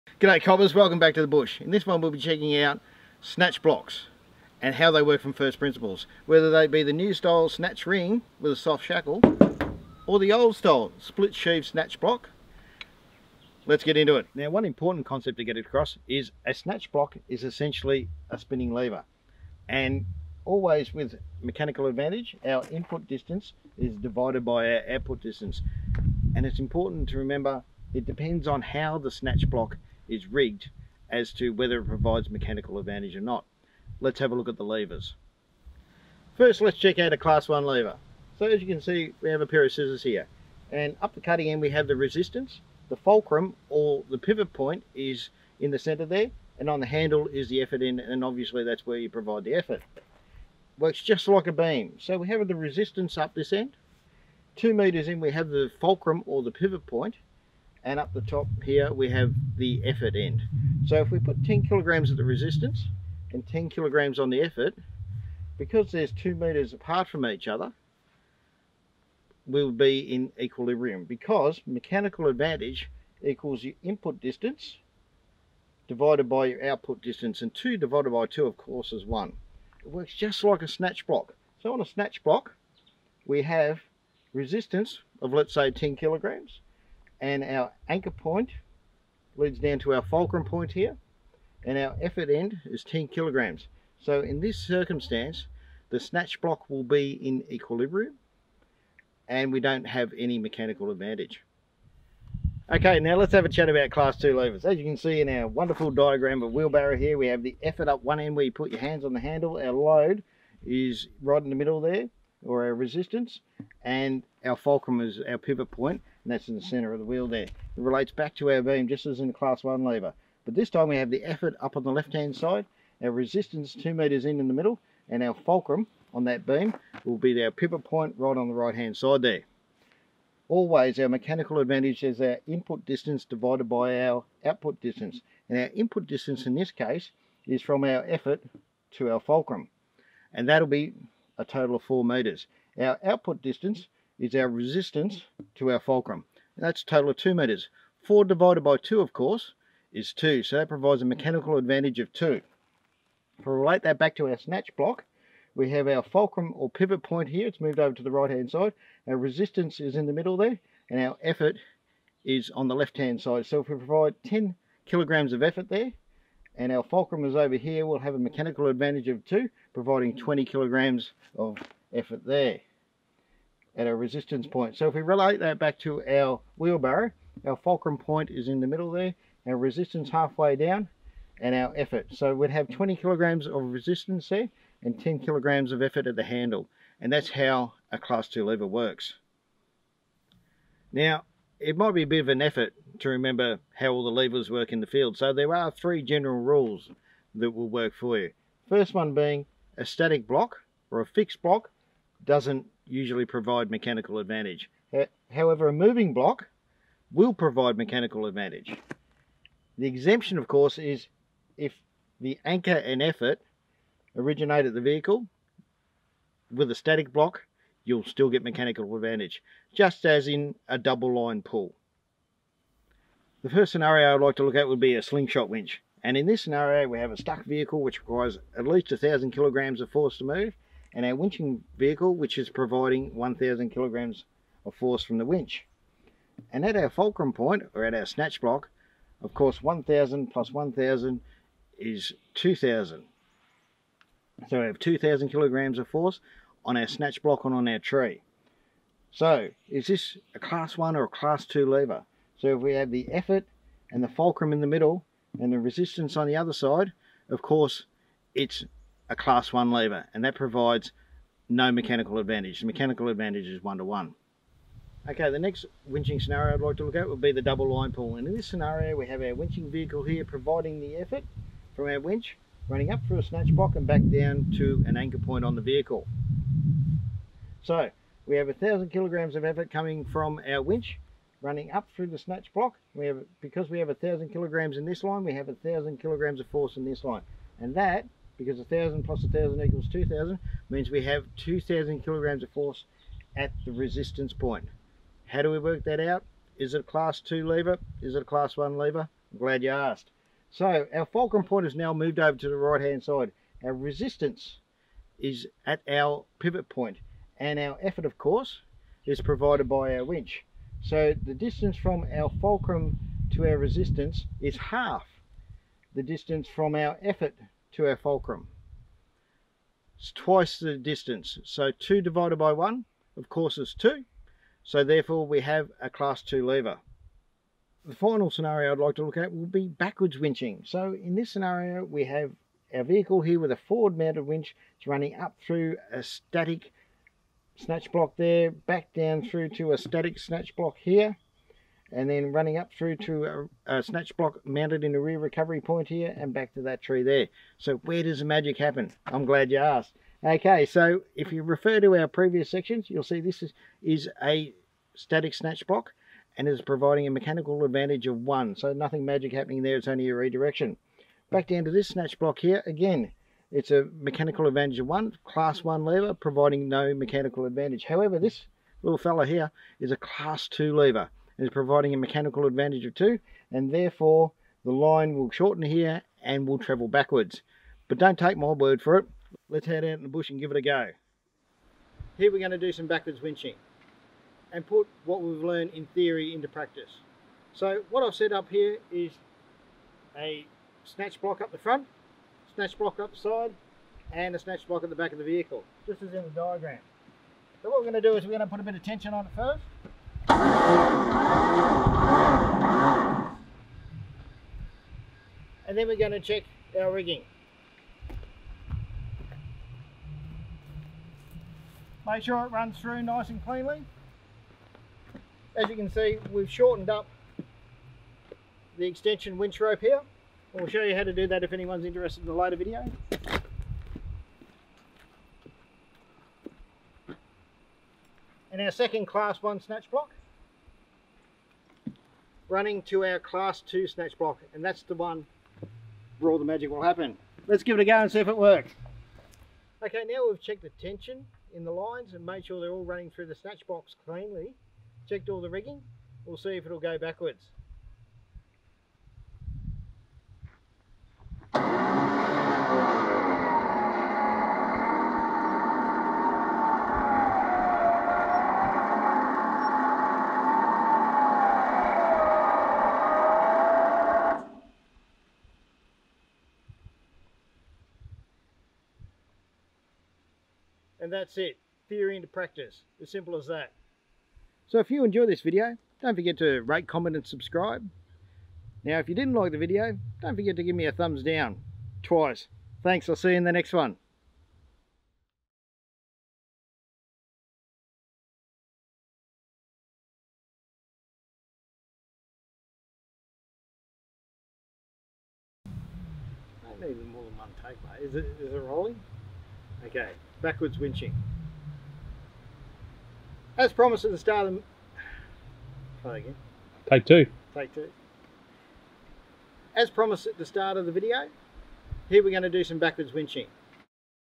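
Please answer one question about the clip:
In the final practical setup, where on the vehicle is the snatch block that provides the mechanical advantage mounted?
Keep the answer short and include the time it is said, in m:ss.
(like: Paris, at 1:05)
Rear recovery point, at 5:44.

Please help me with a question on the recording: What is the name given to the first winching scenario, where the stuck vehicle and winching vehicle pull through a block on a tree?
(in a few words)
Slingshot winch.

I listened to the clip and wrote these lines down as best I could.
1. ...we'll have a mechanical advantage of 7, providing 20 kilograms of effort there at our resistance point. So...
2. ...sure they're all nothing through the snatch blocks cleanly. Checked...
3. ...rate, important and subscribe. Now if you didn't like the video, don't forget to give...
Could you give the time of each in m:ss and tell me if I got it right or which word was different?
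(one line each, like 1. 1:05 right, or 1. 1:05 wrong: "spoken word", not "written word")
1. 2:47 wrong: "2", not "7"
2. 7:22 wrong: "running", not "nothing"
3. 7:56 wrong: "comment", not "important".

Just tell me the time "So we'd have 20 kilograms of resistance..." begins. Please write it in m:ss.
3:02.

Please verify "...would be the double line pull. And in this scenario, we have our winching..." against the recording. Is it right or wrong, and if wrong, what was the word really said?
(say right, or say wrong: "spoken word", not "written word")
right.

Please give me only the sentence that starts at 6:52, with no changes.
Make sure it runs through nice and cleanly.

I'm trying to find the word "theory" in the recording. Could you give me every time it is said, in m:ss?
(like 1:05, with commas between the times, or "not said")
6:25, 7:51.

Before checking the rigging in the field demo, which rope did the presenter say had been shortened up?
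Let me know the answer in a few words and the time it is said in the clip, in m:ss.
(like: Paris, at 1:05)
Extension winch rope, at 6:58.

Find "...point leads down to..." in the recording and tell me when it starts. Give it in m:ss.
1:28.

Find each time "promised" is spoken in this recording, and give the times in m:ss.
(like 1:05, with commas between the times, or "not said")
8:23, 8:29.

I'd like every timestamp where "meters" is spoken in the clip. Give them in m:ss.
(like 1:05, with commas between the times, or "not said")
0:54, 1:06, 2:03, 2:22.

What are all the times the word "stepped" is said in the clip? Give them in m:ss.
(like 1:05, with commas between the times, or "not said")
not said.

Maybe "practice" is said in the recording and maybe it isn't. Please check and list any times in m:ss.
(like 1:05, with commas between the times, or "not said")
6:26, 7:52.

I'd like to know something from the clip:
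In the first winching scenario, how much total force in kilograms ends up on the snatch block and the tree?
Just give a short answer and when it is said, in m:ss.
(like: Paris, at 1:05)
2000 kilograms, at 4:04.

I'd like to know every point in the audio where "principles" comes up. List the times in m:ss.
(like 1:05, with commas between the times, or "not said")
0:05.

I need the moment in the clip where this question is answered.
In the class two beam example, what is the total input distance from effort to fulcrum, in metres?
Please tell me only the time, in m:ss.
2:21.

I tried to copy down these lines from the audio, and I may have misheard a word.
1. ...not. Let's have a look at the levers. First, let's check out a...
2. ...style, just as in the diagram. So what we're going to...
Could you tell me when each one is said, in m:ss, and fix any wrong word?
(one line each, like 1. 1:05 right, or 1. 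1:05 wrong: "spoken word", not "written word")
1. 0:33 right
2. 6:35 wrong: "vehicle", not "style".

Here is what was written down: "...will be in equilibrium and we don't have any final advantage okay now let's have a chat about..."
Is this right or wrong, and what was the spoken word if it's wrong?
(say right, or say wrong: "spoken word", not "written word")
wrong: "mechanical", not "final".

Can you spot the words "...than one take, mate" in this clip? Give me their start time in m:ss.
8:17.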